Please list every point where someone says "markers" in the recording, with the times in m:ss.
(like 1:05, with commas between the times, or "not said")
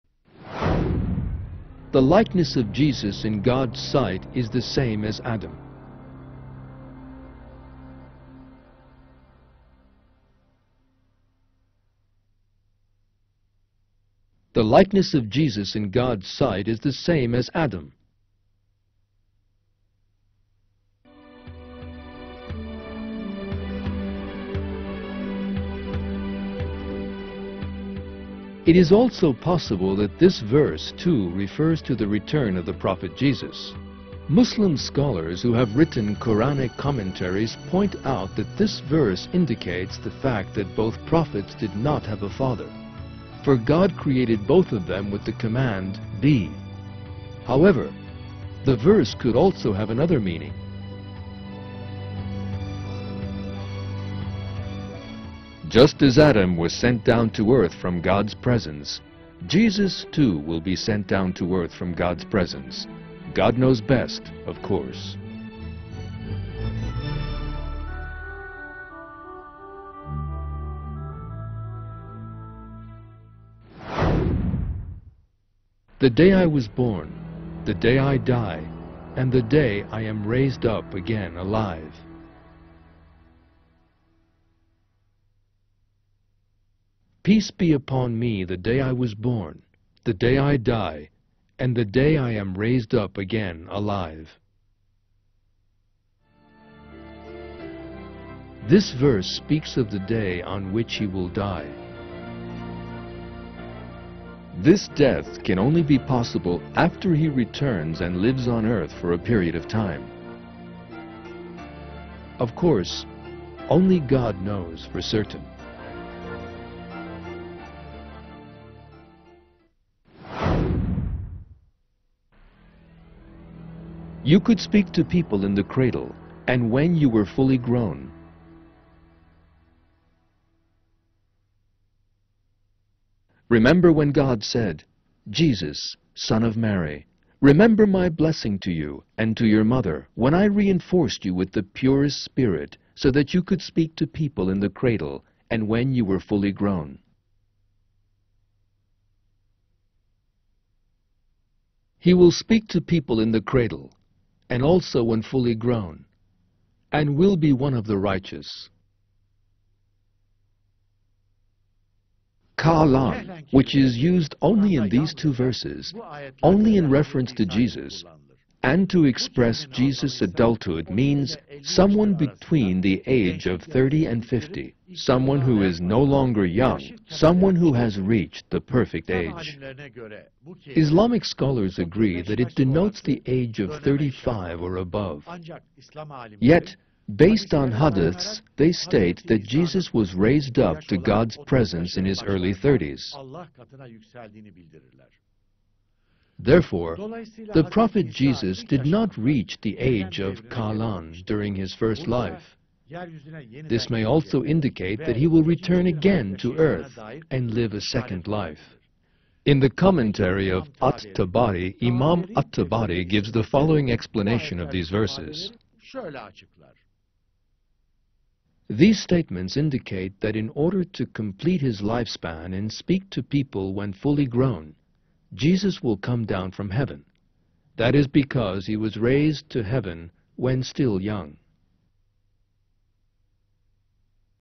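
not said.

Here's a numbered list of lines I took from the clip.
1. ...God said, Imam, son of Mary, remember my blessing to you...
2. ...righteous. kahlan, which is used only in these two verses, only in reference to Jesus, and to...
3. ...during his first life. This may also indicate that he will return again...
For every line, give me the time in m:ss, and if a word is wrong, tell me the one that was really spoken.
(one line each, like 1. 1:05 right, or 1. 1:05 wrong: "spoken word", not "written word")
1. 2:14 wrong: "Jesus", not "Imam"
2. 2:37 right
3. 3:21 right.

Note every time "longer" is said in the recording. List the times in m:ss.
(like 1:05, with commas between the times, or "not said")
2:56.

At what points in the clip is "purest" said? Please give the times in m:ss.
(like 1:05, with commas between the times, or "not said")
2:21.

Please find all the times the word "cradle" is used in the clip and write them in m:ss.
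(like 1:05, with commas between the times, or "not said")
2:05, 2:24, 2:33.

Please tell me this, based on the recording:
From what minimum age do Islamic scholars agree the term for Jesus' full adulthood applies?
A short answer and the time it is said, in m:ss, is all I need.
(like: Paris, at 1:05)
35, at 3:03.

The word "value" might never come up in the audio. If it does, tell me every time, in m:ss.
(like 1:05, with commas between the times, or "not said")
not said.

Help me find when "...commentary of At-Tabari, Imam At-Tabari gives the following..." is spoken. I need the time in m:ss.
3:29.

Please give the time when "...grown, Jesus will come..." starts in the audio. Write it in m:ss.
3:44.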